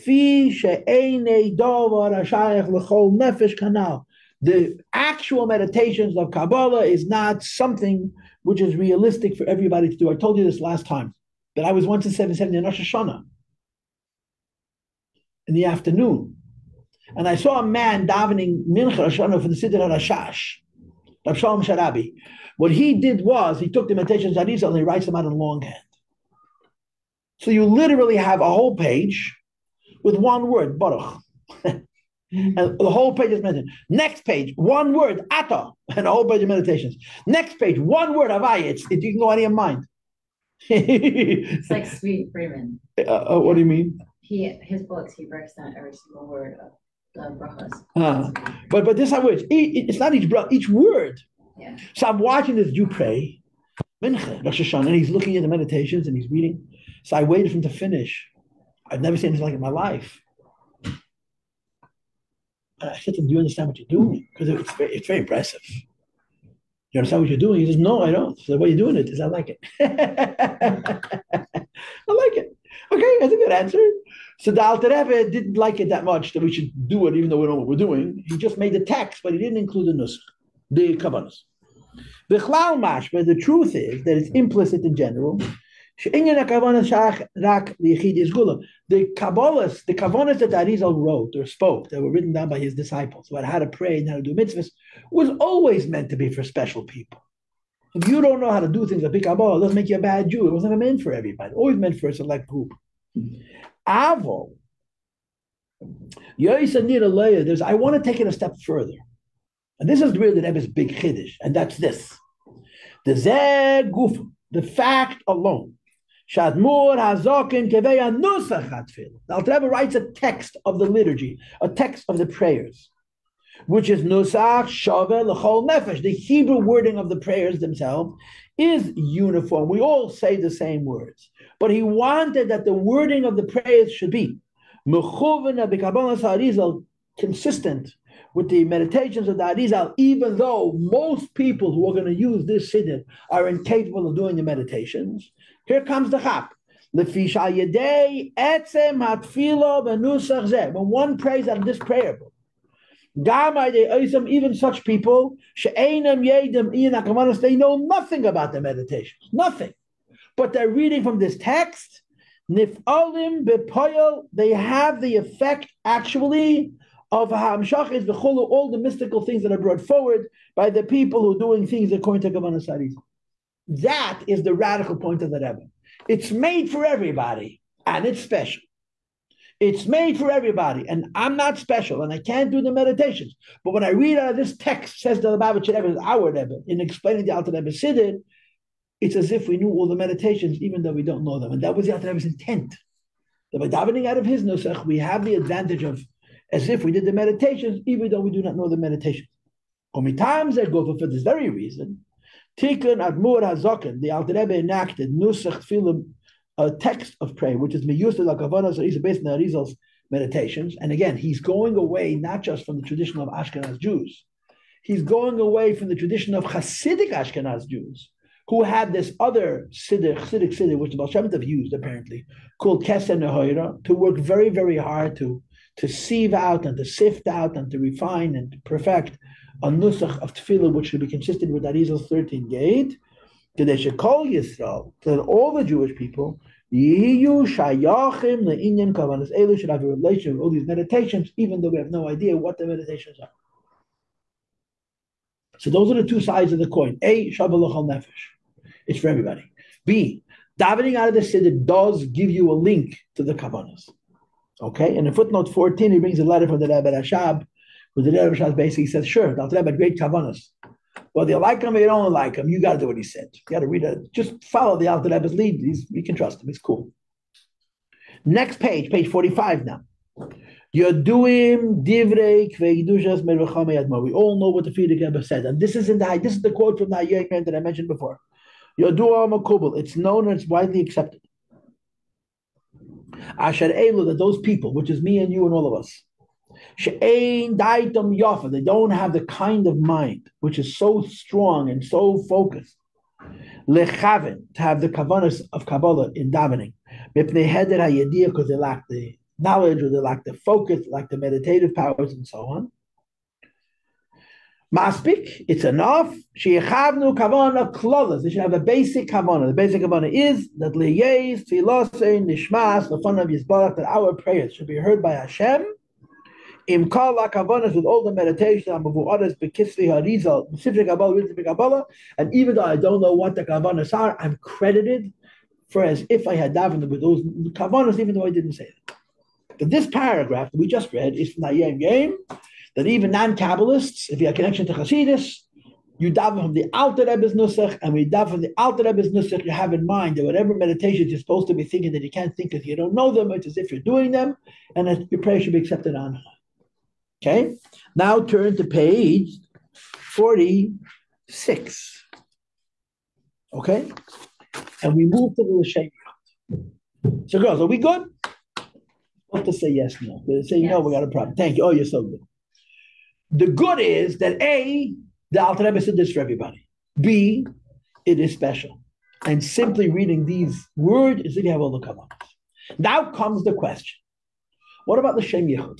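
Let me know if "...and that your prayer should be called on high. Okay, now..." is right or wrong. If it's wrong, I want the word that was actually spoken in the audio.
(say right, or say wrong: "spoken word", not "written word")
wrong: "accepted", not "called".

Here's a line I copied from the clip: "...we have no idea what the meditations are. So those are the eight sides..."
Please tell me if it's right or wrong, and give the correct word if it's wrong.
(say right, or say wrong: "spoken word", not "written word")
wrong: "two", not "eight".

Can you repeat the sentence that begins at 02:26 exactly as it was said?
When one prays out of this prayer book, even such people, they know nothing about the meditation, nothing.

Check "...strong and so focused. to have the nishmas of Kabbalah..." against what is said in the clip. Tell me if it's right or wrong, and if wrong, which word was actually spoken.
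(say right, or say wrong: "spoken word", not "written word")
wrong: "kavanas", not "nishmas".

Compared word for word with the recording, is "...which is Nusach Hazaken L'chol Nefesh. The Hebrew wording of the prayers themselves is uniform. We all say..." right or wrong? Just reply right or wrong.
wrong.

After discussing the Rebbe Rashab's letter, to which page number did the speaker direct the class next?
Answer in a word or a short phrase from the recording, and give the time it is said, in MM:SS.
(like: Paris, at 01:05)
45, at 04:29.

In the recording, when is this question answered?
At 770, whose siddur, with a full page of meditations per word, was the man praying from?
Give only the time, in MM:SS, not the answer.
00:21.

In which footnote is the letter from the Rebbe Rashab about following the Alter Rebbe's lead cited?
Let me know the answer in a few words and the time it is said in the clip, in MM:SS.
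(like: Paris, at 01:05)
14, at 04:15.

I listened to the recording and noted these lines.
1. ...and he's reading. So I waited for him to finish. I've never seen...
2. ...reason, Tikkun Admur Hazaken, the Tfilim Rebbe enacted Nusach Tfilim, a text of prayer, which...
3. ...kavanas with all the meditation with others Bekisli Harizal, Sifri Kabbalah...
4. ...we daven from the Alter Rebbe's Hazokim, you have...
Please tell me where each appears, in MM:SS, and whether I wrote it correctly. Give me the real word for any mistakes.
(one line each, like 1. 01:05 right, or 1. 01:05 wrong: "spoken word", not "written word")
1. 00:56 right
2. 03:21 wrong: "Alter", not "Tfilim"
3. 05:17 right
4. 05:37 wrong: "Nusach", not "Hazokim".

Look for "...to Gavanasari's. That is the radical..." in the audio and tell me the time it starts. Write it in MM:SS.
02:52.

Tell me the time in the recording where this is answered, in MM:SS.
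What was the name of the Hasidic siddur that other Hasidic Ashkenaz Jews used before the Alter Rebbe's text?
03:42.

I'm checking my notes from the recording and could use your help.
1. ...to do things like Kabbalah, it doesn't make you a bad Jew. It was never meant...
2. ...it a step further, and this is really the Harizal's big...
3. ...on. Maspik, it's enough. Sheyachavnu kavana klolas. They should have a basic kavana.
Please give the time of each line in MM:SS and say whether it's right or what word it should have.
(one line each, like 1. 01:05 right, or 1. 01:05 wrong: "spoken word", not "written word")
1. 01:38 right
2. 01:48 wrong: "Rebbe", not "Harizal"
3. 05:02 right.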